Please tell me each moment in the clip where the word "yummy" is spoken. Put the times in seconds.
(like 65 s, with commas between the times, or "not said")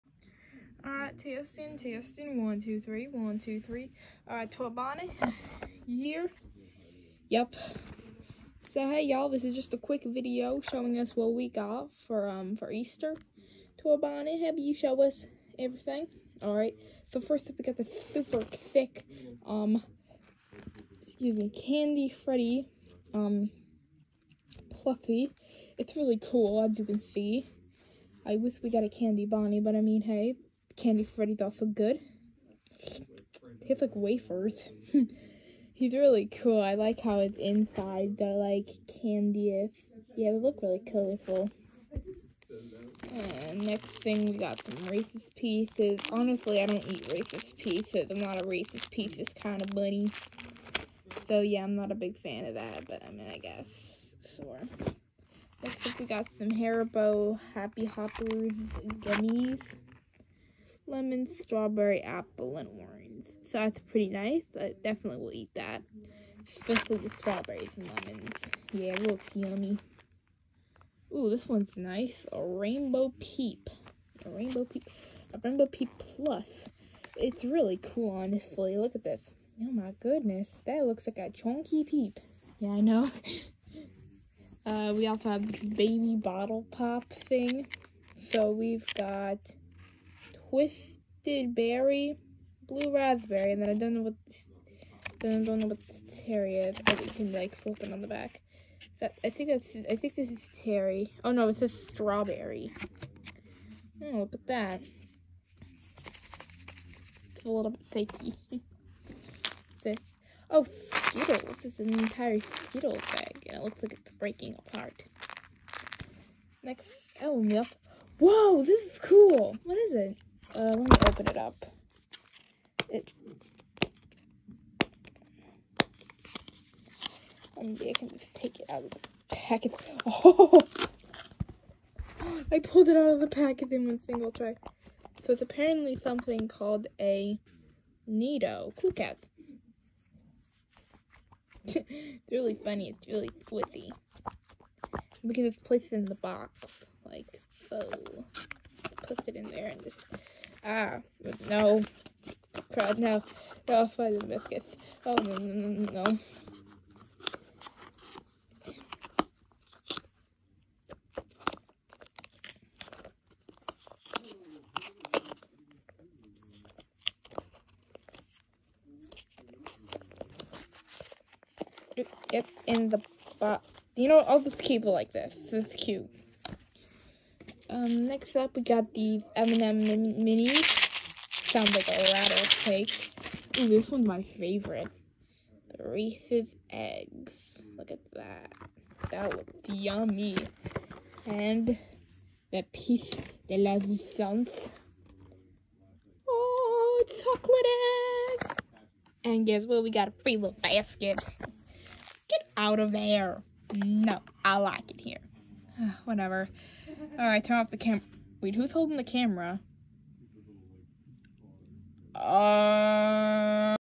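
69 s, 189 s.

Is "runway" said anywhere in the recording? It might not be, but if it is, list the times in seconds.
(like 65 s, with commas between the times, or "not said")
not said.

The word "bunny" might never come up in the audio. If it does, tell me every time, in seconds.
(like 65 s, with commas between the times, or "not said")
49 s.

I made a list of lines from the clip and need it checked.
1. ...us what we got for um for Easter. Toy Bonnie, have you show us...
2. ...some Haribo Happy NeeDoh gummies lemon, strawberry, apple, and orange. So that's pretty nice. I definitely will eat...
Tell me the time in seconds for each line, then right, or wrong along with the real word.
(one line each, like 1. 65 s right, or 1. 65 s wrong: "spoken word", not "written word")
1. 10 s right
2. 56 s wrong: "Hoppers", not "NeeDoh".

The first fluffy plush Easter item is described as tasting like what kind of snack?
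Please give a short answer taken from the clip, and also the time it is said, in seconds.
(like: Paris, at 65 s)
Wafers, at 33 s.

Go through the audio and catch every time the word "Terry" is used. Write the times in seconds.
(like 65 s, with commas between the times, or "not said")
96 s, 100 s.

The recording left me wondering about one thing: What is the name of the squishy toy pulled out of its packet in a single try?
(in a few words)
NeeDoh Cool Cats.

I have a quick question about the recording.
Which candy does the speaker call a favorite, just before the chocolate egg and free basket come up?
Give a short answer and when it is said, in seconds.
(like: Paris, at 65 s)
Reese's Eggs, at 185 s.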